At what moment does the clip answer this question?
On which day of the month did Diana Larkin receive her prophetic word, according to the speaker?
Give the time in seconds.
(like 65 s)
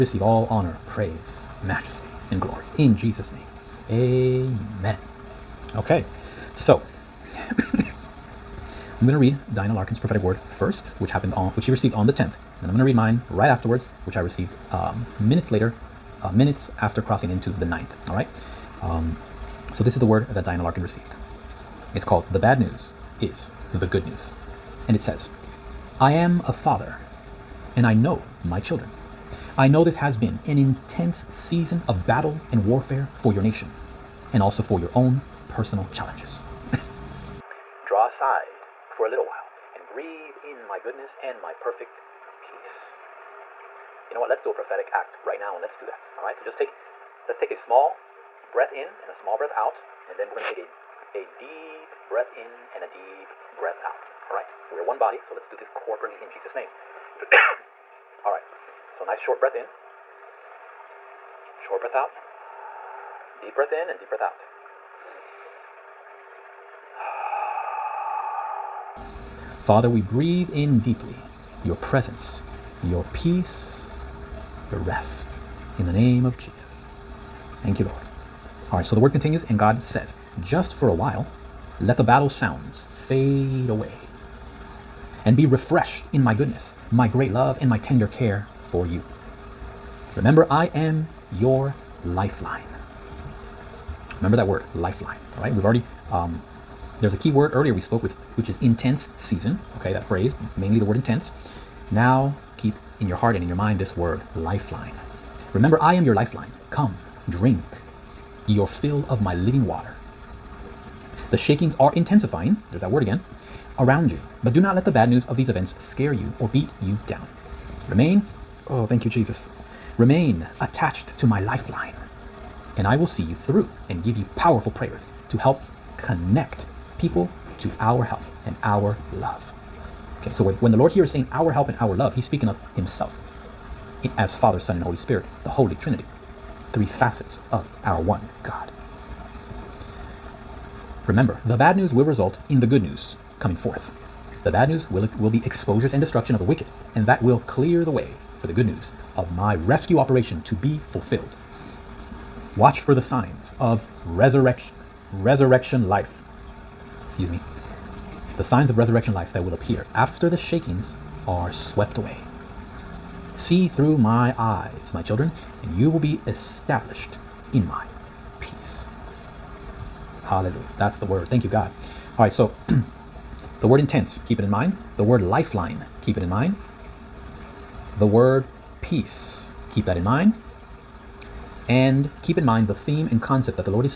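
12 s.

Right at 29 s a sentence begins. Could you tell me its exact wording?
I know this has been an intense season of battle and warfare for your nation, and also for your own personal challenges.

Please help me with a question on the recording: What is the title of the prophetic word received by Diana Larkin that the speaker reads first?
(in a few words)
The Bad News is the Good News.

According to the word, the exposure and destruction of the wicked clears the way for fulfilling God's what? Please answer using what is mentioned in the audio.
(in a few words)
rescue operation.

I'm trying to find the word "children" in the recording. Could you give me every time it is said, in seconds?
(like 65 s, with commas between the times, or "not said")
28 s, 165 s.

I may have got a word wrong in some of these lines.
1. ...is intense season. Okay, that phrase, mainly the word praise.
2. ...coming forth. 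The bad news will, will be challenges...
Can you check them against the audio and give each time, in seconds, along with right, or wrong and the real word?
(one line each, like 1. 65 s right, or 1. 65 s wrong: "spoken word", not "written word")
1. 98 s wrong: "intense", not "praise"
2. 143 s wrong: "exposures", not "challenges".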